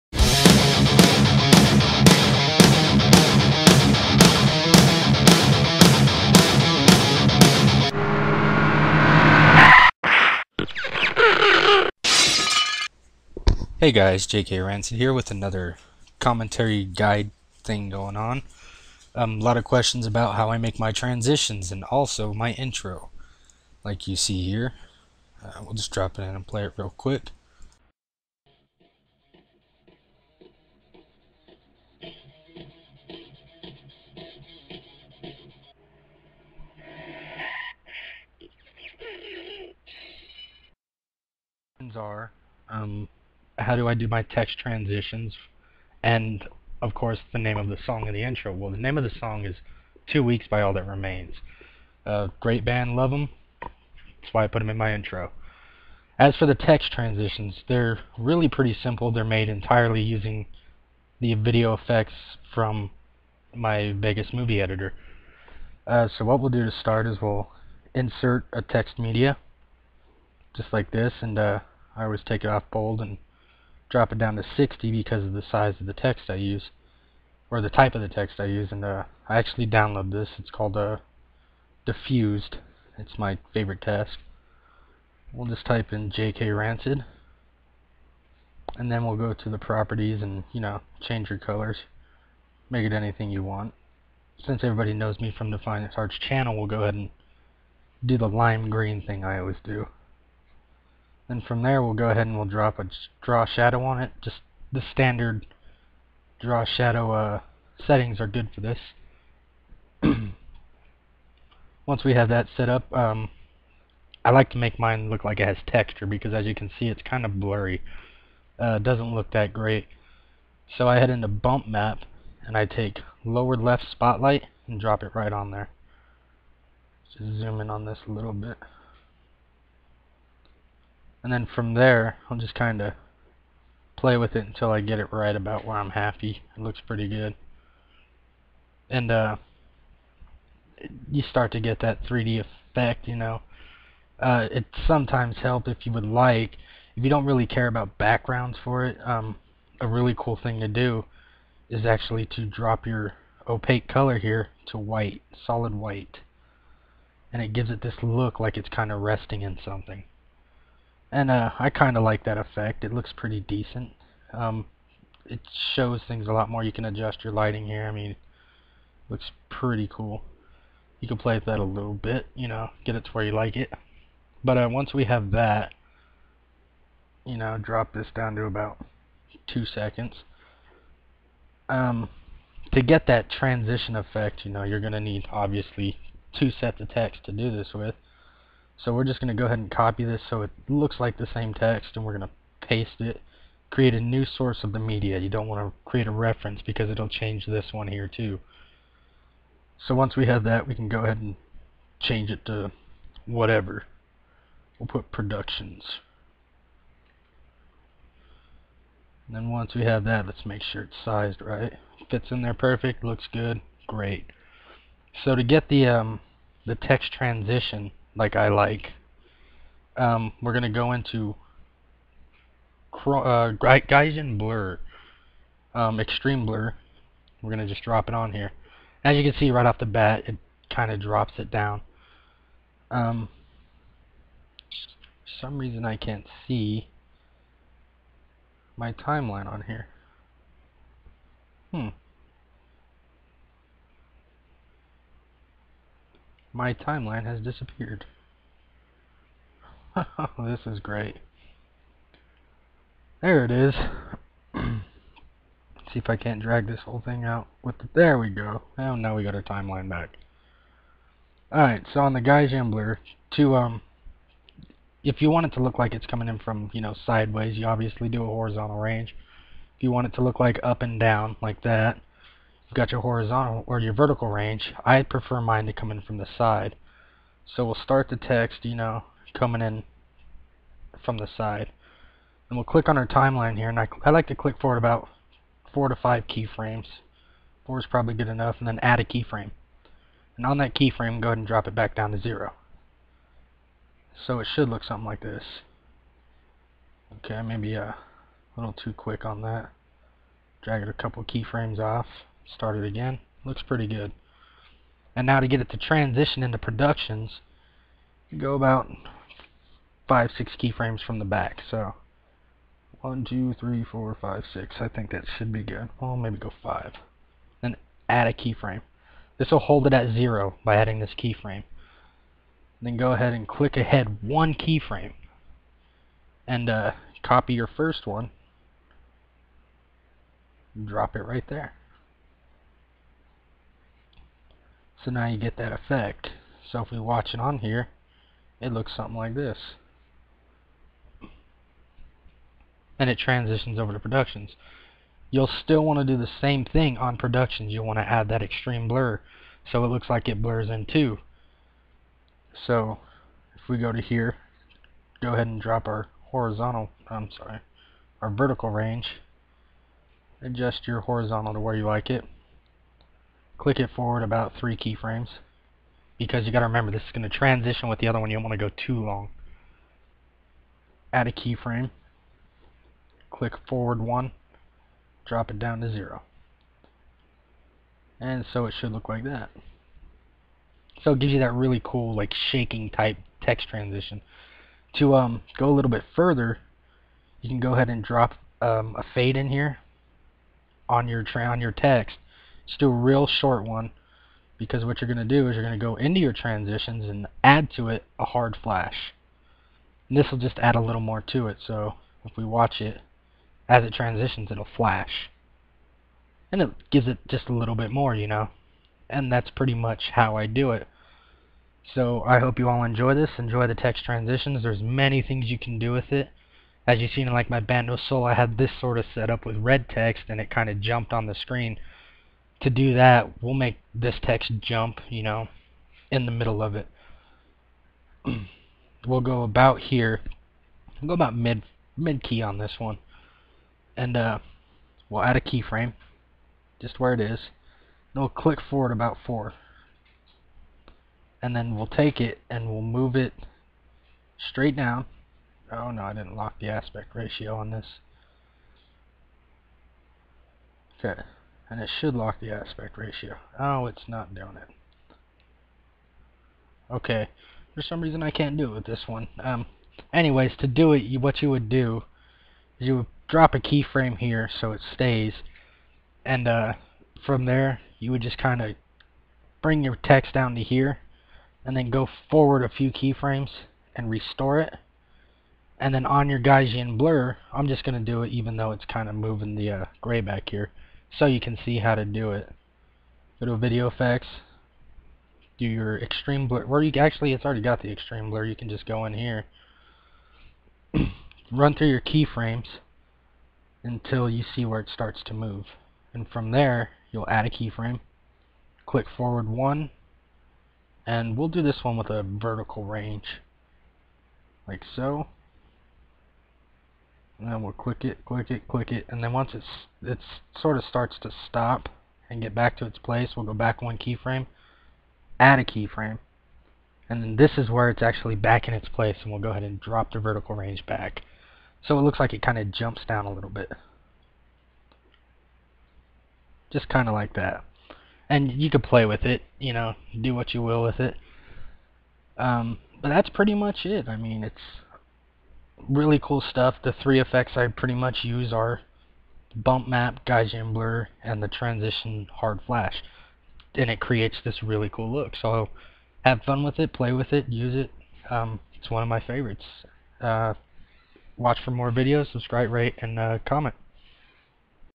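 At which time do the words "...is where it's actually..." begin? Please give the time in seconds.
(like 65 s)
517 s.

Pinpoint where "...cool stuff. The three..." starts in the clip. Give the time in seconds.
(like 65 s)
536 s.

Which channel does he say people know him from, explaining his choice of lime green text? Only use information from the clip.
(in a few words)
Fine Arts channel.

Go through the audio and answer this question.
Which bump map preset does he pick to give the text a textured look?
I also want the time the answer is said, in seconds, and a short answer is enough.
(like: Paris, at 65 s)
Lower left spotlight, at 123 s.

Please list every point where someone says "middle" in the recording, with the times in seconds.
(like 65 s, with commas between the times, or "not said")
426 s.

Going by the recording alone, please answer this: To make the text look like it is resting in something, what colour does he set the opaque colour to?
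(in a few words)
Solid white.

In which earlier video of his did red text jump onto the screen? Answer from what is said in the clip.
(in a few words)
Bandos Solo.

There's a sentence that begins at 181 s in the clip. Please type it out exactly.
Um, to get that transition effect, you know, you're going to need, obviously, two sets of text to do this with.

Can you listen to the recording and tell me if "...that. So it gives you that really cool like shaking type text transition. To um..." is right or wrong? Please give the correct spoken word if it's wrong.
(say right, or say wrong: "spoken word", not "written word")
right.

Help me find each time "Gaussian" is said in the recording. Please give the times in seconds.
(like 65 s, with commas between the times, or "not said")
476 s, 540 s.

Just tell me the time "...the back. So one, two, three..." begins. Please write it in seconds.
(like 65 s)
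311 s.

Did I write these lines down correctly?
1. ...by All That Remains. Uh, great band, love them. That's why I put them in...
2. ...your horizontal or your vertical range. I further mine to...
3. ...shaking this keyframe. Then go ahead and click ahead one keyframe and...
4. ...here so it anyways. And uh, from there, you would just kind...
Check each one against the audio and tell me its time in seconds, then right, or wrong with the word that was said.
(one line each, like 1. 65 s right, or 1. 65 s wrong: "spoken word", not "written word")
1. 50 s right
2. 272 s wrong: "prefer", not "further"
3. 320 s wrong: "adding", not "shaking"
4. 464 s wrong: "stays", not "anyways".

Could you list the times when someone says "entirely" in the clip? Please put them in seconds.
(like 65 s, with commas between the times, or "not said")
59 s.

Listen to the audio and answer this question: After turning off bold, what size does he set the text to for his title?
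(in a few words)
60.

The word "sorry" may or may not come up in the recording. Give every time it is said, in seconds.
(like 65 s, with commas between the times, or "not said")
357 s.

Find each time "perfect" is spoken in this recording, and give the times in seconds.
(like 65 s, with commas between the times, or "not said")
212 s.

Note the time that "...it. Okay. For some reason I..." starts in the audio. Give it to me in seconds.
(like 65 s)
454 s.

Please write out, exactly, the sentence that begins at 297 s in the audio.
Okay, maybe uh, a little too quick on that.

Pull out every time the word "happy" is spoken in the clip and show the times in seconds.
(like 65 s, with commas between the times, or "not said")
135 s.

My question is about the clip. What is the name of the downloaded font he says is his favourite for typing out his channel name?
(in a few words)
Diffused.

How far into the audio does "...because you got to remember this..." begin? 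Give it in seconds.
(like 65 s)
366 s.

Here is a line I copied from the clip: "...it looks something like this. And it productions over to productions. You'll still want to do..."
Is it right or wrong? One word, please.
wrong.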